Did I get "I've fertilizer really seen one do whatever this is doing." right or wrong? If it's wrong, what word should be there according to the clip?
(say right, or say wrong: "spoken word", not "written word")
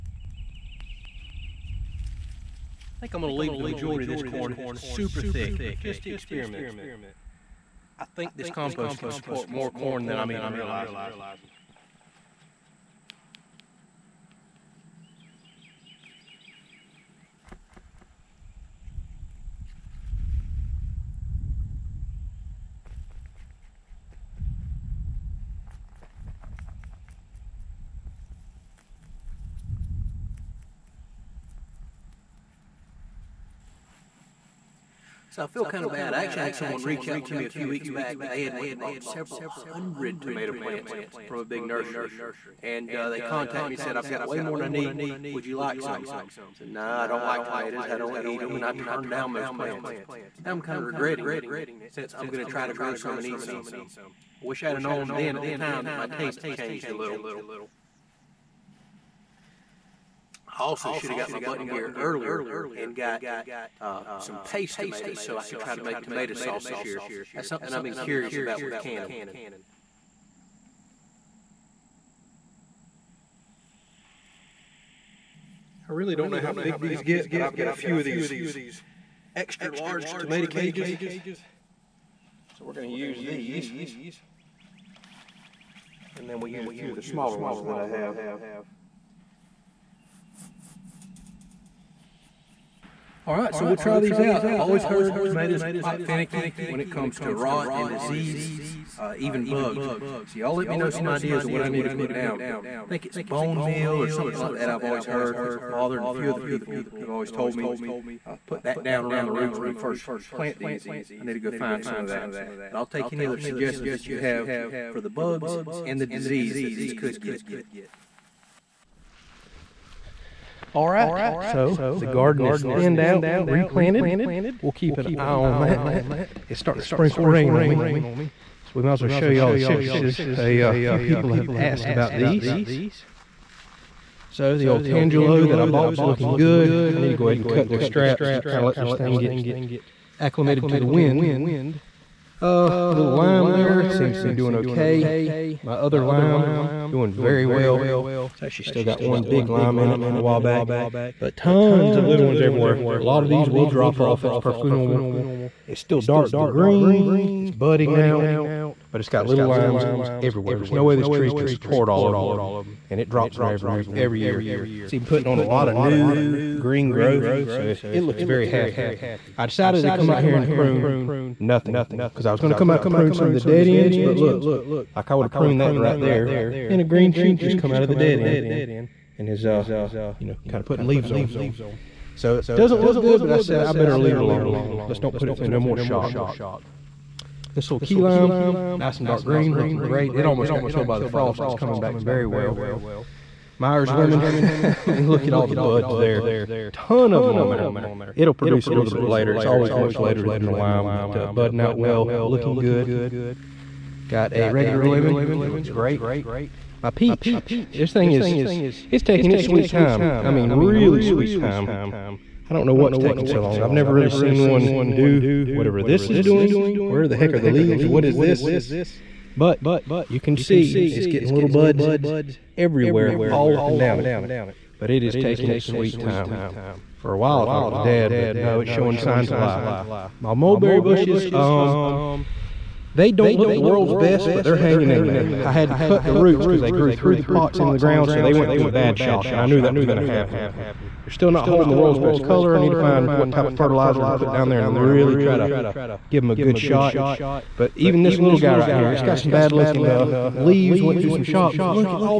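wrong: "never", not "fertilizer".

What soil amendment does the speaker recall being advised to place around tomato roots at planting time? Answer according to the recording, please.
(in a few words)
bone meal.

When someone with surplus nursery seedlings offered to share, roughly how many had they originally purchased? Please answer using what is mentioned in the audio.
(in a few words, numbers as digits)
several hundred.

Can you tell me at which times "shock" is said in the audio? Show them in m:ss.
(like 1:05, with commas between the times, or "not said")
3:05, 3:58, 4:11.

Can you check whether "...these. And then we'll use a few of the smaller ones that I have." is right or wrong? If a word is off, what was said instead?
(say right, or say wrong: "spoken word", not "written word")
right.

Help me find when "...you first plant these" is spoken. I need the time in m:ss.
1:49.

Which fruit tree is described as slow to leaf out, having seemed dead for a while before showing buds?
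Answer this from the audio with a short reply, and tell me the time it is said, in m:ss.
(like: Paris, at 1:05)
peach, at 3:26.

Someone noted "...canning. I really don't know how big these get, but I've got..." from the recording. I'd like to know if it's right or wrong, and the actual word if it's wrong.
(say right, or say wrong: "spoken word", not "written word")
right.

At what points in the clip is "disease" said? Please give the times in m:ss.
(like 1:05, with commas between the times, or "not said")
1:37, 1:56.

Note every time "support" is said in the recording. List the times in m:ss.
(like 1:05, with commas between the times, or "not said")
0:09, 2:41.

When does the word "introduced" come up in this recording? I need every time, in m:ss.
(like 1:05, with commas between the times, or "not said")
not said.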